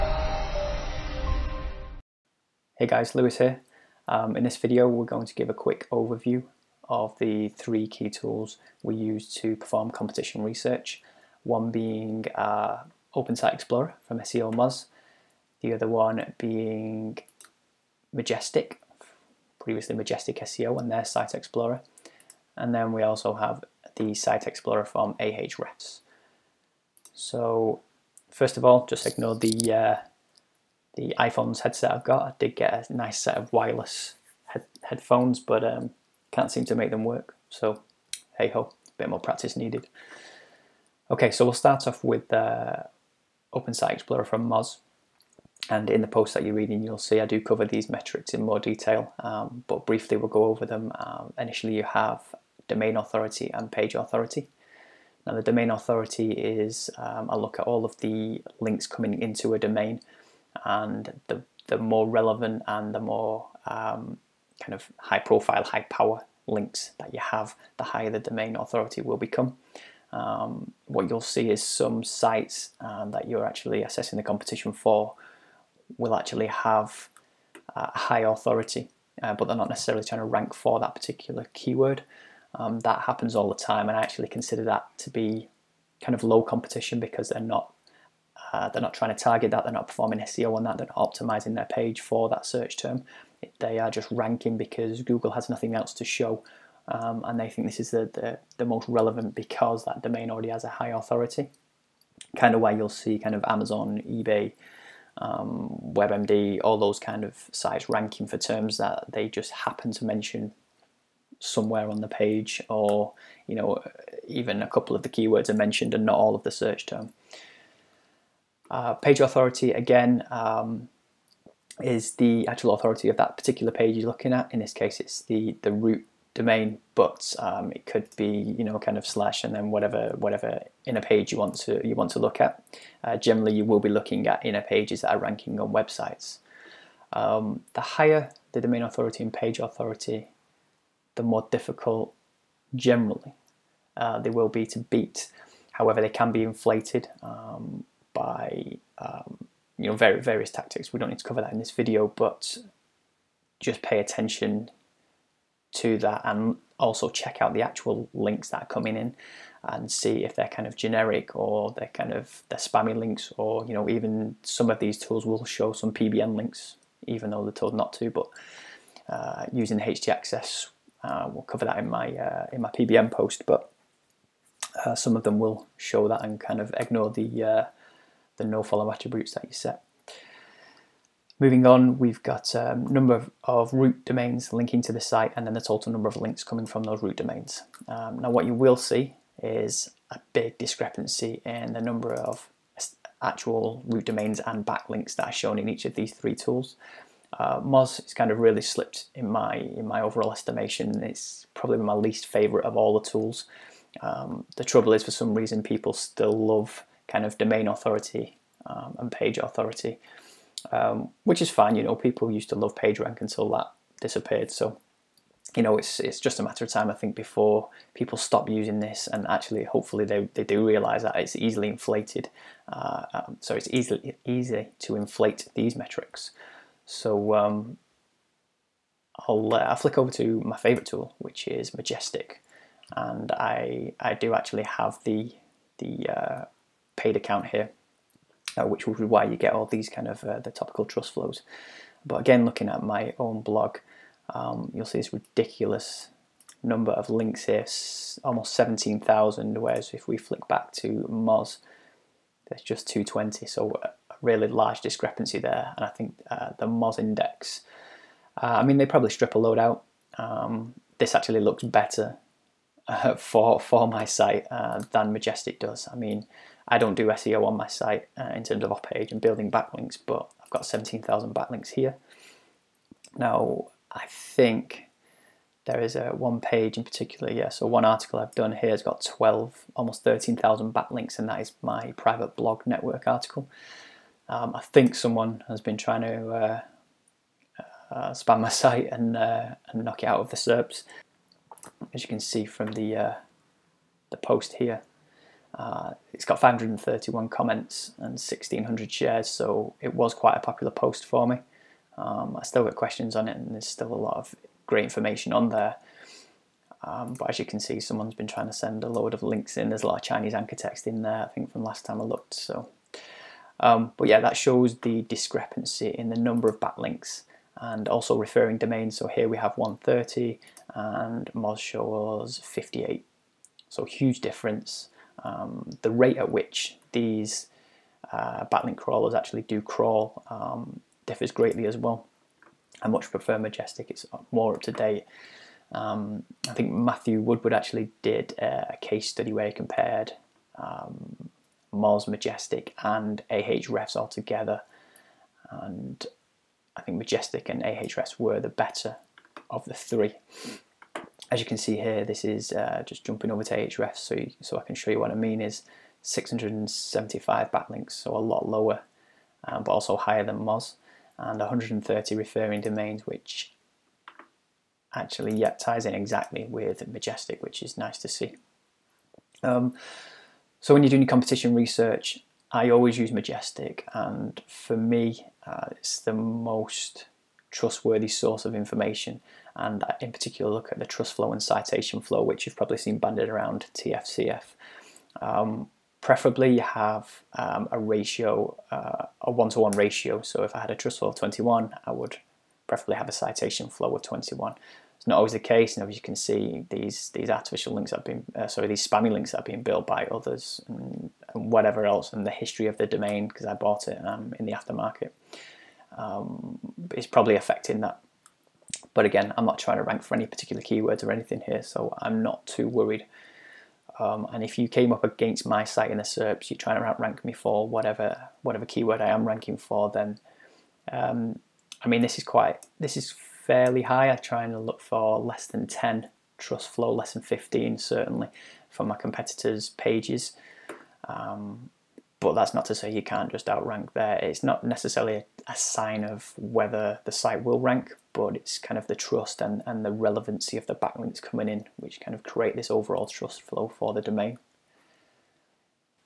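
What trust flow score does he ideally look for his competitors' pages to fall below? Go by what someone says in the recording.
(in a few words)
10.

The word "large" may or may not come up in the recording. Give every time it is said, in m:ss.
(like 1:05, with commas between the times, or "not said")
4:14.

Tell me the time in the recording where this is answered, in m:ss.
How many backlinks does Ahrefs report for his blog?
5:56.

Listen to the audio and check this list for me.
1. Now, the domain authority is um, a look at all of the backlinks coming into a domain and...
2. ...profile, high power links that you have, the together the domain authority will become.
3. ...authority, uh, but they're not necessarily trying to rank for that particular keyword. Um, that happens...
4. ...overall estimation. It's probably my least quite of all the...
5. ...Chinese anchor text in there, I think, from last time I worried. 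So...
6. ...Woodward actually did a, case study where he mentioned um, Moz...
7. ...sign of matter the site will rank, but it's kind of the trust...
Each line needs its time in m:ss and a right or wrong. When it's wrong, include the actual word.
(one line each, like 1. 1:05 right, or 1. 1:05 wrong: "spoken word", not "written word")
1. 0:55 wrong: "links", not "backlinks"
2. 1:05 wrong: "higher", not "together"
3. 1:18 right
4. 3:19 wrong: "favorite", not "quite"
5. 5:10 wrong: "looked", not "worried"
6. 5:37 wrong: "compared", not "mentioned"
7. 7:15 wrong: "whether", not "matter".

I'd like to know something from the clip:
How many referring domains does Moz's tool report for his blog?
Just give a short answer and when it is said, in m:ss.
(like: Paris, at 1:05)
58, at 5:22.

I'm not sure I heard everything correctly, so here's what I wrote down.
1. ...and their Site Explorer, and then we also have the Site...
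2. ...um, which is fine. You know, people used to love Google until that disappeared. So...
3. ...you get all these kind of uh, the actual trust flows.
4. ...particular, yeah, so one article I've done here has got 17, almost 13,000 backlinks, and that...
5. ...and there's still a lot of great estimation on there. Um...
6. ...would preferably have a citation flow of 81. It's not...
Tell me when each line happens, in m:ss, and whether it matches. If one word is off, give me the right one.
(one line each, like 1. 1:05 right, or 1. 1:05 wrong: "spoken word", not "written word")
1. 0:20 right
2. 3:30 wrong: "PageRank", not "Google"
3. 3:59 wrong: "topical", not "actual"
4. 4:36 wrong: "12", not "17"
5. 5:03 wrong: "information", not "estimation"
6. 6:31 wrong: "21", not "81".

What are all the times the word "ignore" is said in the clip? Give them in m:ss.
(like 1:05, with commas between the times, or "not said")
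0:29, 2:56.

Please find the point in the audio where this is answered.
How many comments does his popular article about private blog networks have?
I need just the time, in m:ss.
4:56.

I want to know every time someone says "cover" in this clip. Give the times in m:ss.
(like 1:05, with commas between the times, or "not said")
0:47, 2:31, 2:51.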